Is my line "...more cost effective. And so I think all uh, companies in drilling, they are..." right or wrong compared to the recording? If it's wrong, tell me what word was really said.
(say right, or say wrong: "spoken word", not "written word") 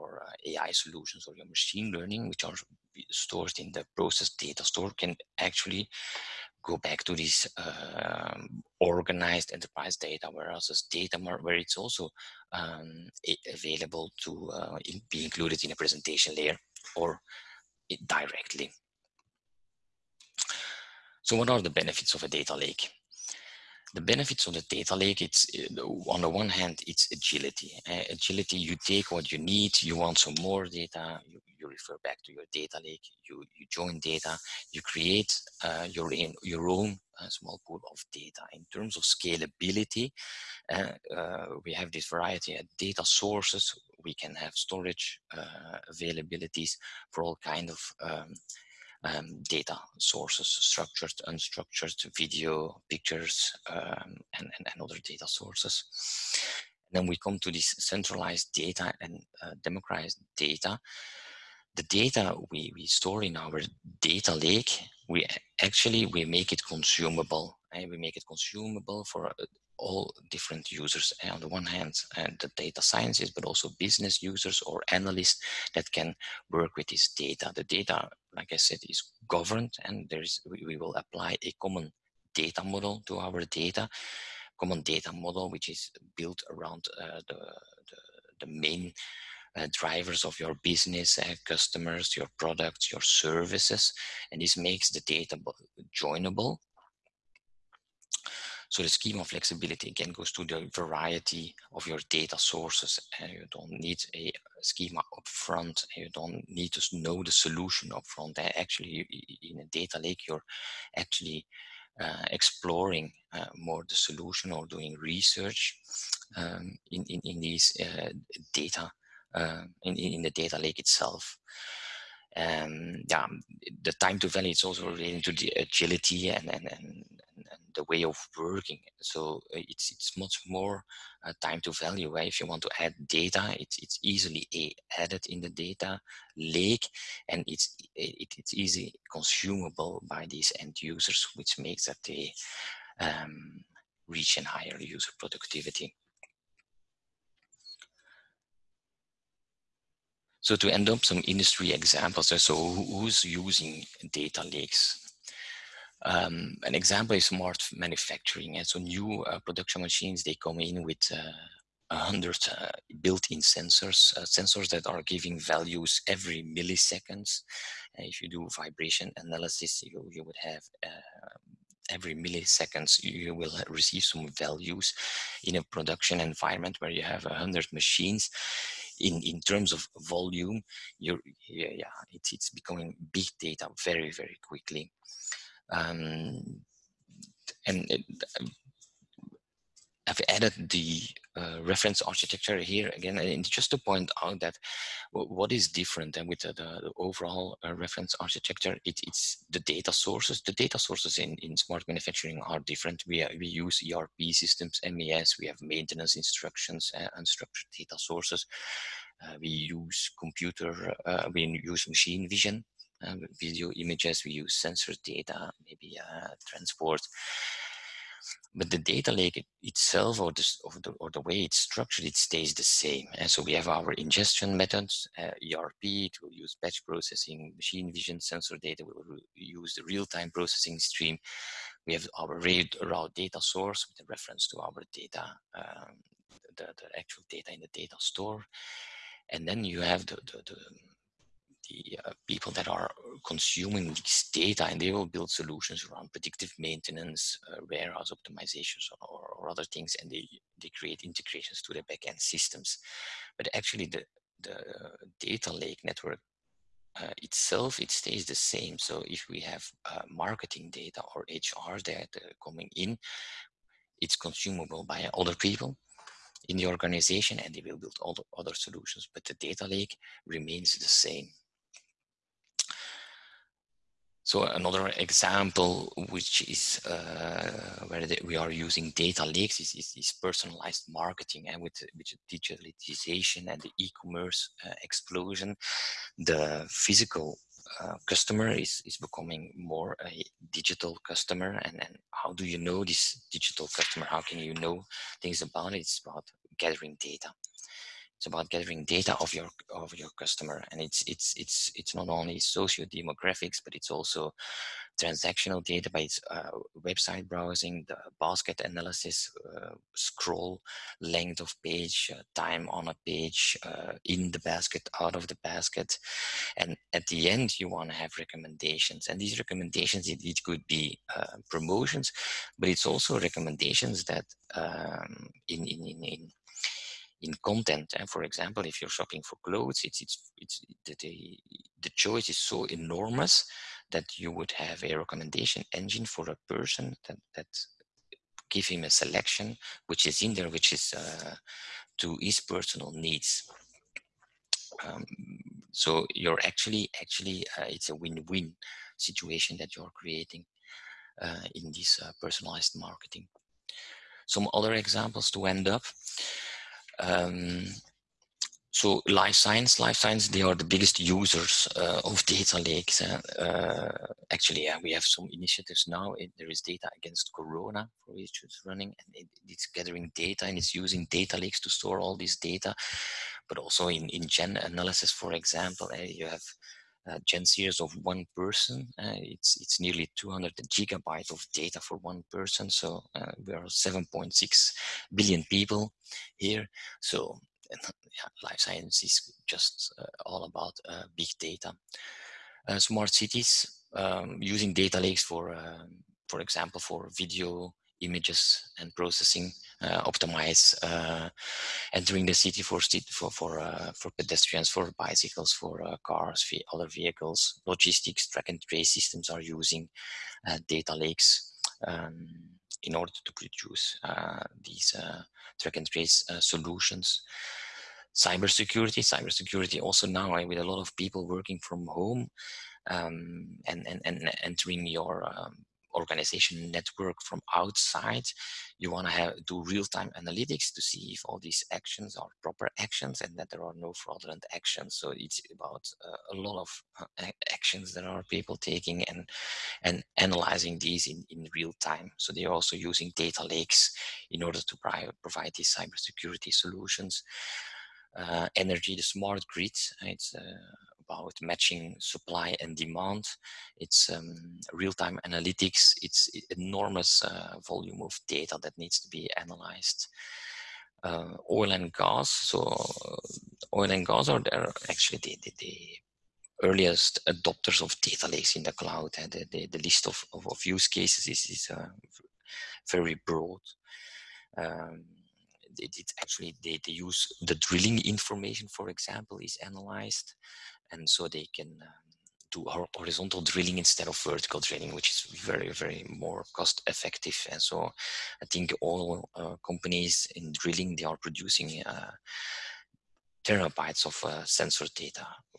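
right.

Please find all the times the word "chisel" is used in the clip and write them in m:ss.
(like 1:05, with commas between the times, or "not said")
not said.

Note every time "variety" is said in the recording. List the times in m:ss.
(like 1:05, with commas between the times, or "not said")
0:42, 1:40.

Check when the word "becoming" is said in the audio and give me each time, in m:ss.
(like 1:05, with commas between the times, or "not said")
3:02, 4:48.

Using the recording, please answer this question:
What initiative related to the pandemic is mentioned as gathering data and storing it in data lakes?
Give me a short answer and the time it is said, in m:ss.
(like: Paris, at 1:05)
data against corona, at 6:06.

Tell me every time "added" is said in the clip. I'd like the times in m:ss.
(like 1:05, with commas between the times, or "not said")
2:14, 3:10.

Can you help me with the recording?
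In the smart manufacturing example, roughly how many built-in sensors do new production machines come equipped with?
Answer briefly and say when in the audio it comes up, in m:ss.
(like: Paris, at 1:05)
100, at 2:41.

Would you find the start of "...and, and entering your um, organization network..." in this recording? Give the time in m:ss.
7:03.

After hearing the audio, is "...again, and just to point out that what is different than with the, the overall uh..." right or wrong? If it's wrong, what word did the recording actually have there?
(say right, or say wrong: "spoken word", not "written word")
right.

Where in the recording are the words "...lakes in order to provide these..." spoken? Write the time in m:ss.
7:23.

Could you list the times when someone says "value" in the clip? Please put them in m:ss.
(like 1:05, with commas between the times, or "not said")
2:04, 2:11, 2:45, 2:54.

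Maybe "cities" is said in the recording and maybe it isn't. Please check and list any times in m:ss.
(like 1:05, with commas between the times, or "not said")
6:33.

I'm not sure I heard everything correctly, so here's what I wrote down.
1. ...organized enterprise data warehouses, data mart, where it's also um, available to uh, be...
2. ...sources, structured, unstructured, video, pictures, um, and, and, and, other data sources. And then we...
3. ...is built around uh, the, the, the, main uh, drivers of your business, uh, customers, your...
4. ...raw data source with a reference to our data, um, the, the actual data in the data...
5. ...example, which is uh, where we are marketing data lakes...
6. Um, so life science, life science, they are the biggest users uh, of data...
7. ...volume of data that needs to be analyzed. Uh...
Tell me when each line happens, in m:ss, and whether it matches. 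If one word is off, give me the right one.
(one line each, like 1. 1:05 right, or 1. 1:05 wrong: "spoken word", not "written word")
1. 0:08 right
2. 0:49 right
3. 1:25 right
4. 3:52 right
5. 4:35 wrong: "using", not "marketing"
6. 5:56 right
7. 7:37 right.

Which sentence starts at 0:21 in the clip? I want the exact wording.
So what are the benefits of a data lake?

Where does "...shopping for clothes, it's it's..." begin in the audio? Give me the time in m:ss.
5:28.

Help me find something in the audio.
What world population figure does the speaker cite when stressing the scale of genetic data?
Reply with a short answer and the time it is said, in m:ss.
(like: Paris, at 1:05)
7.6 billion, at 6:23.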